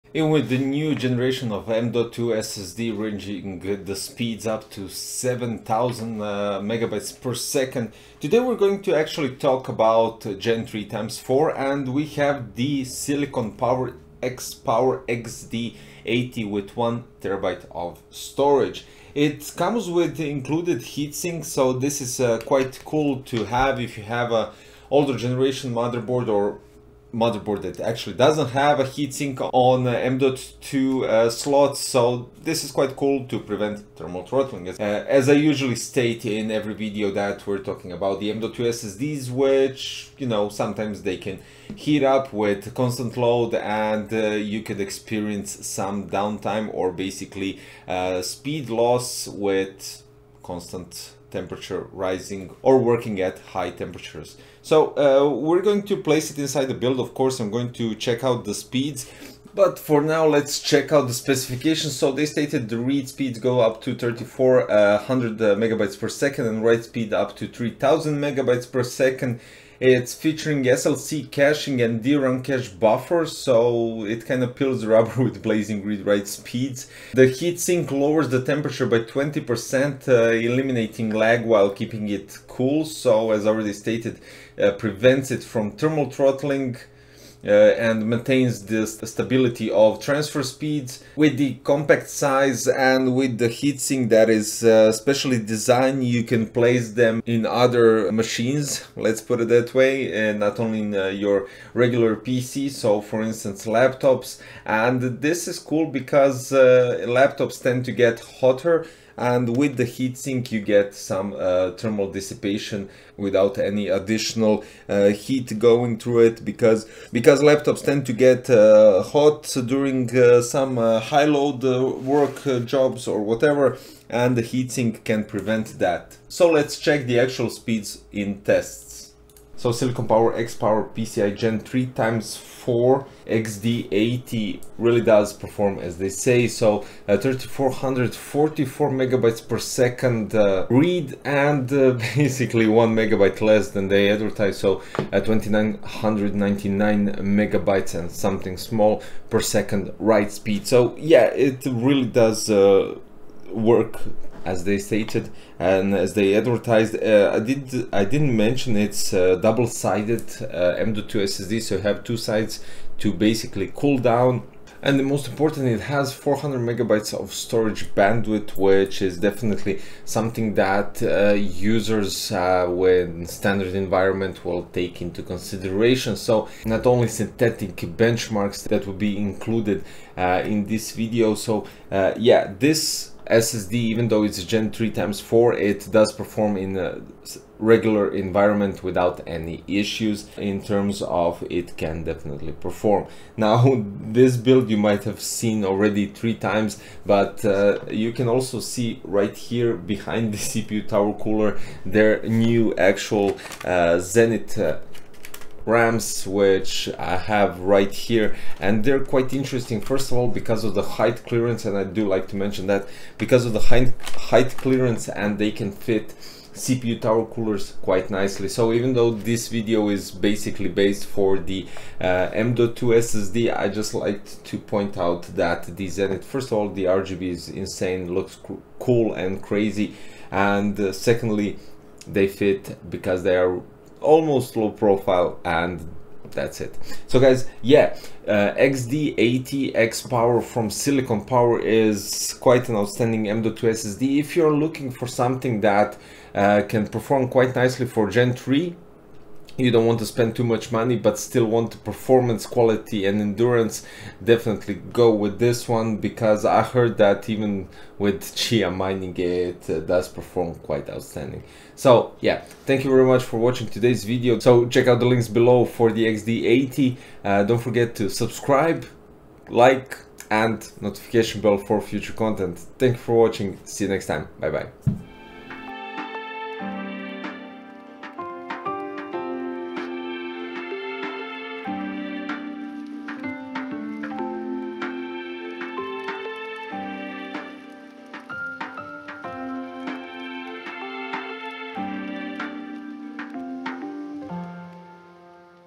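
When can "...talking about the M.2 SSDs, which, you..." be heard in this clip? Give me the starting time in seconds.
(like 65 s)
37 s.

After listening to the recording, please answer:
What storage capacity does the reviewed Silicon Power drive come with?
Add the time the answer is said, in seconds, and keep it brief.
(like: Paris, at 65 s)
1 terabyte, at 16 s.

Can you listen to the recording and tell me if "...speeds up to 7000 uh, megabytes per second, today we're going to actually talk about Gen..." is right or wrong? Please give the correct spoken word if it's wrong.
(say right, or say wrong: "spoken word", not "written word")
right.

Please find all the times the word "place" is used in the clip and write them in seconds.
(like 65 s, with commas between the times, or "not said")
55 s, 96 s.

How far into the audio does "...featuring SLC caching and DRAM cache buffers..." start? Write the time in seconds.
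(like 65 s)
70 s.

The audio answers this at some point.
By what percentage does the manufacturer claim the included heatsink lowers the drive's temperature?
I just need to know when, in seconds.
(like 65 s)
78 s.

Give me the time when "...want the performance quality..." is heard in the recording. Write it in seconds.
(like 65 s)
251 s.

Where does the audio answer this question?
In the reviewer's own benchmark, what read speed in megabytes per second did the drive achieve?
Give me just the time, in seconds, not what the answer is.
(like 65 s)
137 s.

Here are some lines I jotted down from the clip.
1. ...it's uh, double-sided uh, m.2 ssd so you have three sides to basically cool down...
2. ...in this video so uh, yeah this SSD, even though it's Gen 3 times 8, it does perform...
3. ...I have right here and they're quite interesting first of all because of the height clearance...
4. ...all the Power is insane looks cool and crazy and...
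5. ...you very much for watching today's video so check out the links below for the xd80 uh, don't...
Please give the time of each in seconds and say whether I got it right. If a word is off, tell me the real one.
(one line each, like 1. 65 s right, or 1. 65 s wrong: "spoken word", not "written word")
1. 158 s wrong: "two", not "three"
2. 180 s wrong: "4", not "8"
3. 206 s right
4. 226 s wrong: "RGB", not "Power"
5. 262 s right.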